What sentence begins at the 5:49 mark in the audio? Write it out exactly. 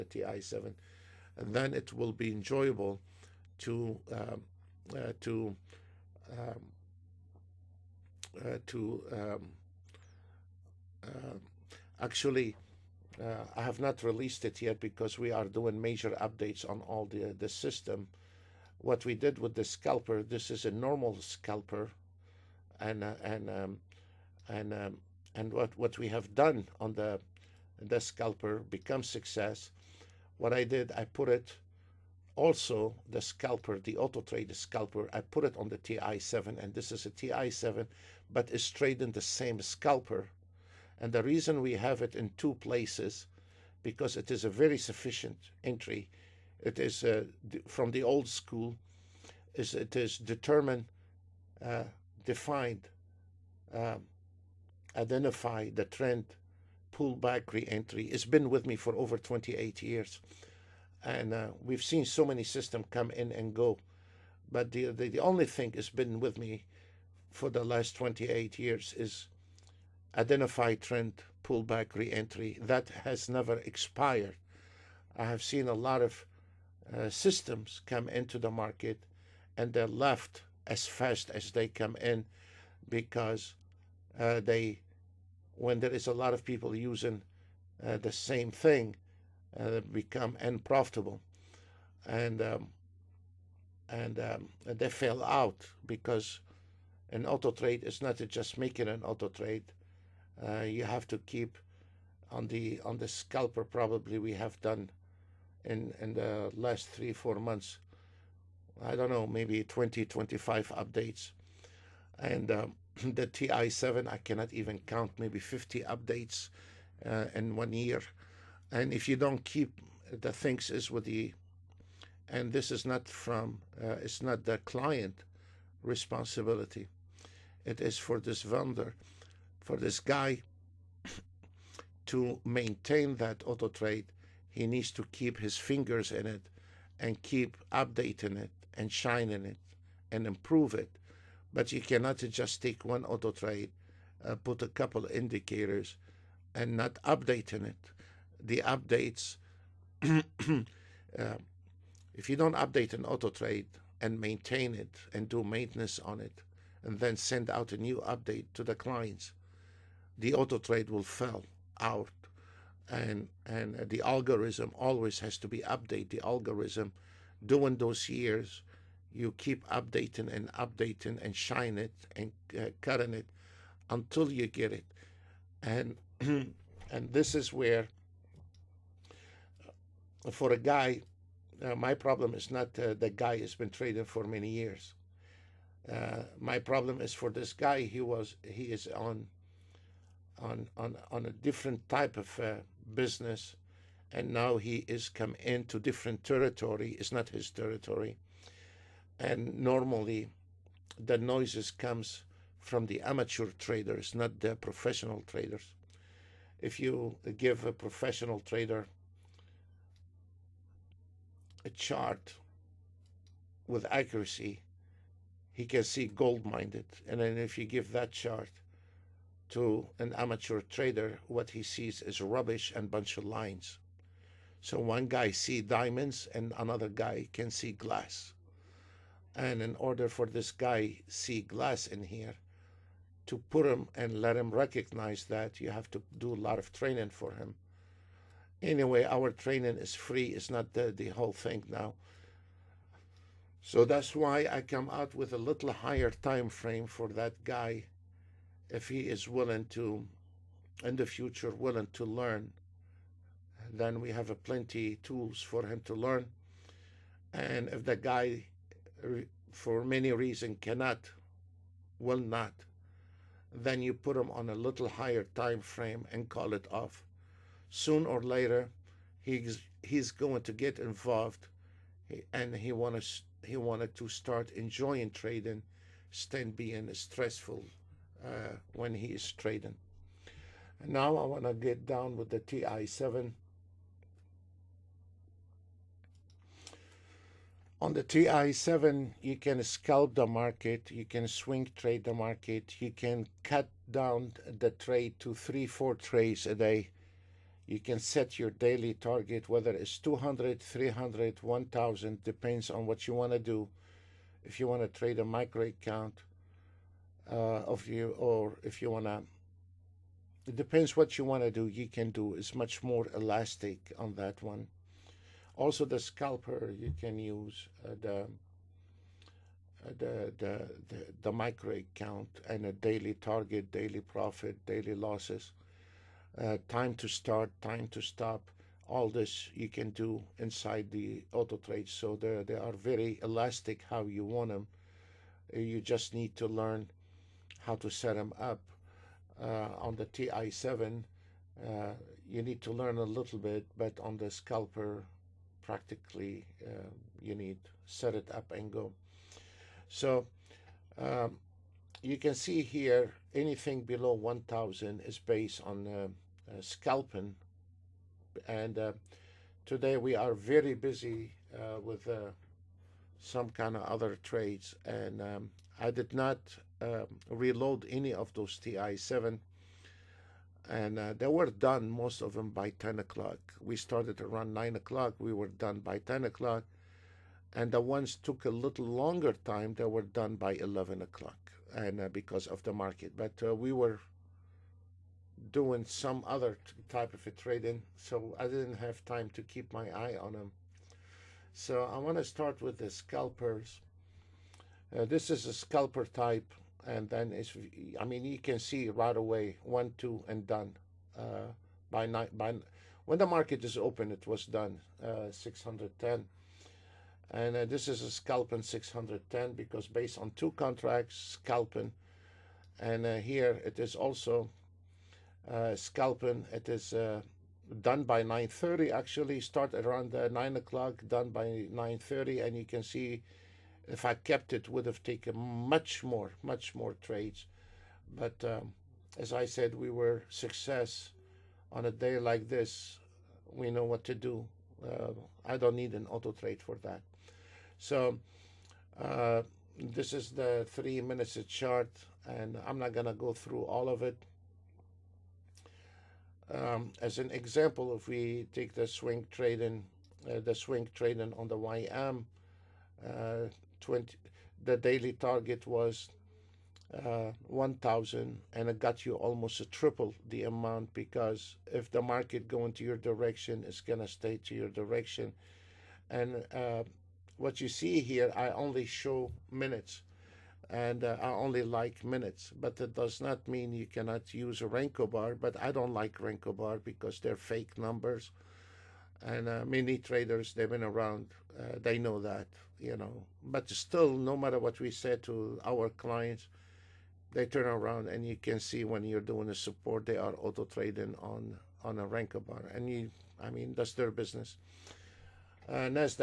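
So um, you can see here anything below 1000 is based on uh, uh, scalping.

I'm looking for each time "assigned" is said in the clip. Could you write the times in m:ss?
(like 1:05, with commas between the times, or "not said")
not said.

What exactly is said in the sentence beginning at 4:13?
Then we have plenty tools for him to learn.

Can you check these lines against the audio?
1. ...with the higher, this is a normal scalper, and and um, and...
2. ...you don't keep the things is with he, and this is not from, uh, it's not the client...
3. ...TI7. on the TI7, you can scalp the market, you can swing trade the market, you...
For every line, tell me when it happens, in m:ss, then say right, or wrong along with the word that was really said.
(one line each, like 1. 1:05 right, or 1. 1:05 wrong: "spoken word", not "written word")
1. 0:19 wrong: "scalper", not "higher"
2. 1:59 right
3. 4:42 right.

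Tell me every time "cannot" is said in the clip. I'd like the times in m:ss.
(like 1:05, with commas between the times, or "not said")
1:54, 2:21, 4:20, 7:53.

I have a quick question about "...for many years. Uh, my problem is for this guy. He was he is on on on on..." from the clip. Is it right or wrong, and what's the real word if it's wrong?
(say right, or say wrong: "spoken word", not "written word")
right.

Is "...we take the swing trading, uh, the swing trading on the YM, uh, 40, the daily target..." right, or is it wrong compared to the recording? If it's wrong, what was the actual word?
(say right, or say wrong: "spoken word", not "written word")
wrong: "20", not "40".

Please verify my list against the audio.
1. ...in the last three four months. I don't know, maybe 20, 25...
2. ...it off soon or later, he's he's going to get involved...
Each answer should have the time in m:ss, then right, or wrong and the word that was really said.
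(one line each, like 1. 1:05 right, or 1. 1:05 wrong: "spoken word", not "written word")
1. 1:45 right
2. 4:26 right.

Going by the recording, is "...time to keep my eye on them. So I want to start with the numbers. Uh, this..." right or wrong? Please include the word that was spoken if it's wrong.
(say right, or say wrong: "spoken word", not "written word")
wrong: "scalpers", not "numbers".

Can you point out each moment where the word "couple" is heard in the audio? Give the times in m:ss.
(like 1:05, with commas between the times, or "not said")
2:24.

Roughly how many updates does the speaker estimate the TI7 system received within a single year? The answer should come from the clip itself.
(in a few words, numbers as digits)
50.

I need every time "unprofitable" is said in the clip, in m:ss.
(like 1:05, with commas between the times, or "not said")
1:30.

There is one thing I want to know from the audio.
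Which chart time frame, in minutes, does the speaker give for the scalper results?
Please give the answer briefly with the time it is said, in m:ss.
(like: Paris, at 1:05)
3 minutes, at 7:20.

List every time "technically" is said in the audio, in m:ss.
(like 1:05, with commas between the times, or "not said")
not said.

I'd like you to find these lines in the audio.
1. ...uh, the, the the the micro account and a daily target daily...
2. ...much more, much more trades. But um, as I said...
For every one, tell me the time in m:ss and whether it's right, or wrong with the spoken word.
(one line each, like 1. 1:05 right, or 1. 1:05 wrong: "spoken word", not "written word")
1. 5:18 right
2. 7:05 right.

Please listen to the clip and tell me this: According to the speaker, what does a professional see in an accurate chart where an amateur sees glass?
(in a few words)
diamonds.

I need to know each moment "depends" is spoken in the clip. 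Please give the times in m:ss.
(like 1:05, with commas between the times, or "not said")
5:02, 5:10.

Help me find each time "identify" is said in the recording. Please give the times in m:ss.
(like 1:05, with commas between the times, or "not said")
0:54, 1:10.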